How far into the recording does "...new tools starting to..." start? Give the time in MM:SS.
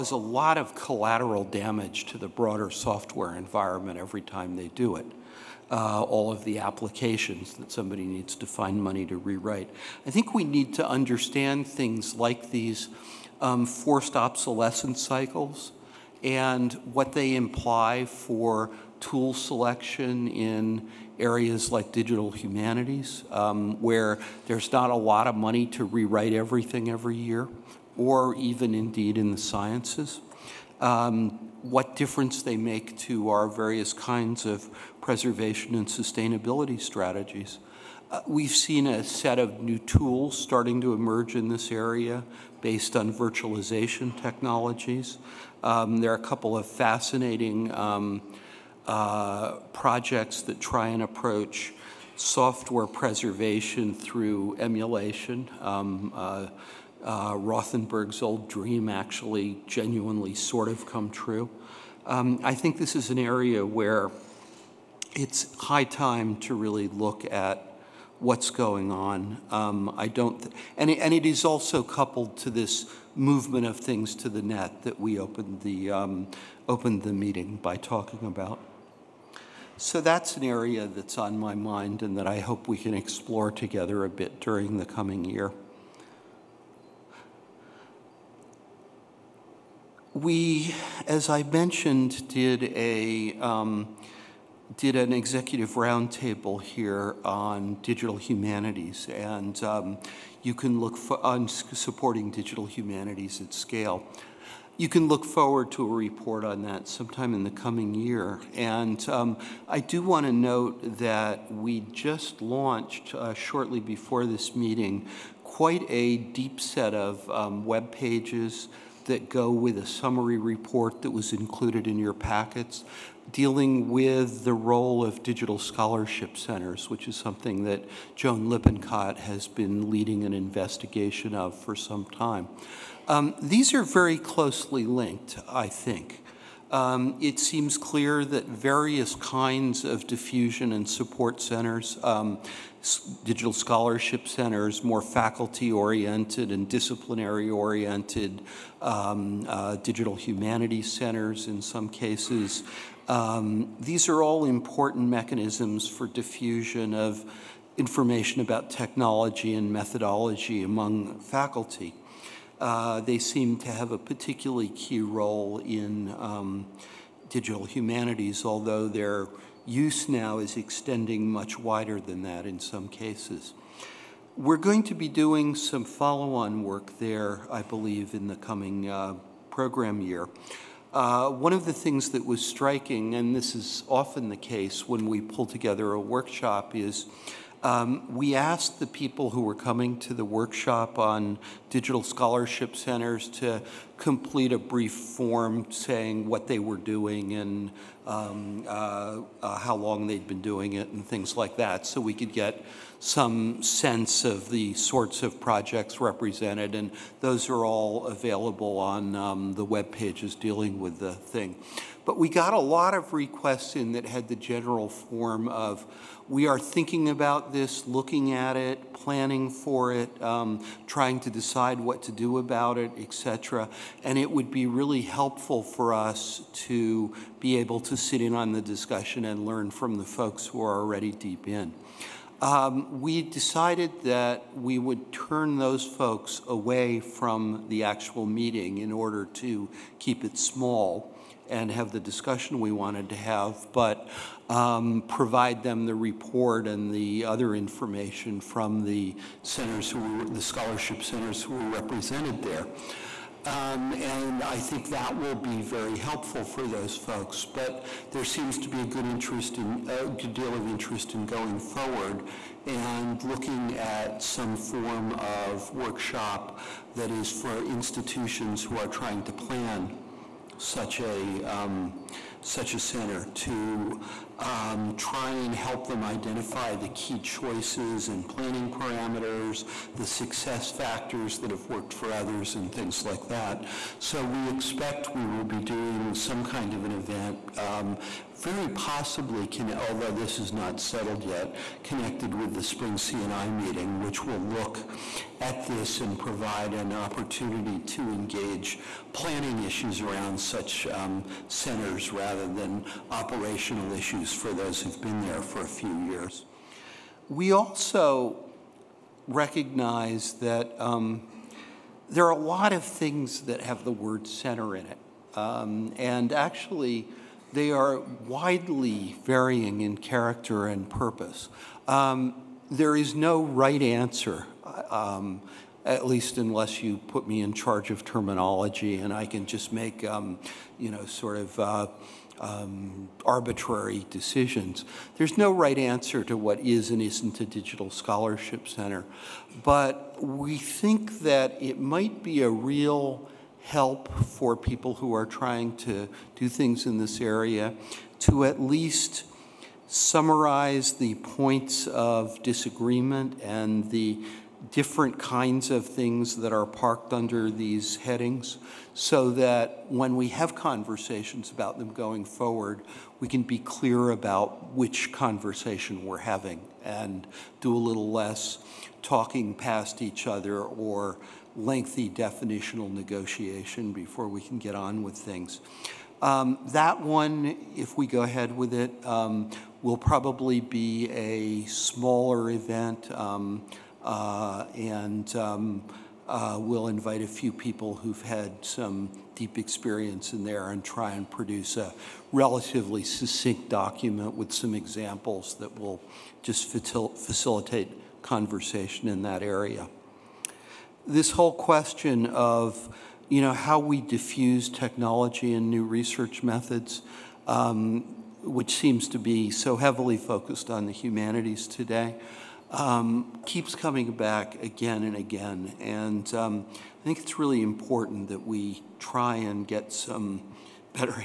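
00:39.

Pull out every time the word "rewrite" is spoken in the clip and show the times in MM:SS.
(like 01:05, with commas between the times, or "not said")
00:09, 00:25.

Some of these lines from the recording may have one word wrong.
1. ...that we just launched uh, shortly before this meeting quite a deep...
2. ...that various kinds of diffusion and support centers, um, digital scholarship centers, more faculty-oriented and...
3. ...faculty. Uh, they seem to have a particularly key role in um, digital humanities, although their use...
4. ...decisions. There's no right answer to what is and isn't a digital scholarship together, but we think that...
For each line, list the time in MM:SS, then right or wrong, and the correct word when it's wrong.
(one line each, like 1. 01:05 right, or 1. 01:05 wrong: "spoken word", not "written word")
1. 01:50 right
2. 02:18 right
3. 02:41 right
4. 05:34 wrong: "center", not "together".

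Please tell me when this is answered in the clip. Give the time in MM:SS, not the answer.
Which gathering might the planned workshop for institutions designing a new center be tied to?
04:52.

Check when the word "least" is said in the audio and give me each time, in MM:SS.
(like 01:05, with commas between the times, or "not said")
05:26, 05:48.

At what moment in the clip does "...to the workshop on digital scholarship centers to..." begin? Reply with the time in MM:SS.
03:10.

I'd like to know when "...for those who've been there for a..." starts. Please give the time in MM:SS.
05:04.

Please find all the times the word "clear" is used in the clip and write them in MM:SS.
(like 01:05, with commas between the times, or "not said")
02:17, 06:03.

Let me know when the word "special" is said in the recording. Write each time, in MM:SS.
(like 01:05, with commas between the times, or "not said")
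not said.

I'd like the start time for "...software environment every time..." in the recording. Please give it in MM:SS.
00:02.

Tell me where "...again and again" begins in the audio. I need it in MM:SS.
06:54.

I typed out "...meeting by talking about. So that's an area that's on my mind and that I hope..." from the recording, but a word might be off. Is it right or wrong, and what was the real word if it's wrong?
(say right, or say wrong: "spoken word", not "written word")
right.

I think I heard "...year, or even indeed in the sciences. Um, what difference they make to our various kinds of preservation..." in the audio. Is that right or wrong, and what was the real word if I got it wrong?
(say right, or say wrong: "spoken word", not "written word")
right.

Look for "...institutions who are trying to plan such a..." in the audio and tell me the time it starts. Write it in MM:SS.
04:27.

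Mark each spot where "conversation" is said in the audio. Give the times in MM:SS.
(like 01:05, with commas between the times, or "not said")
06:00, 06:05, 06:38.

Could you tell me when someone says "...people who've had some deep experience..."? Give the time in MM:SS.
06:27.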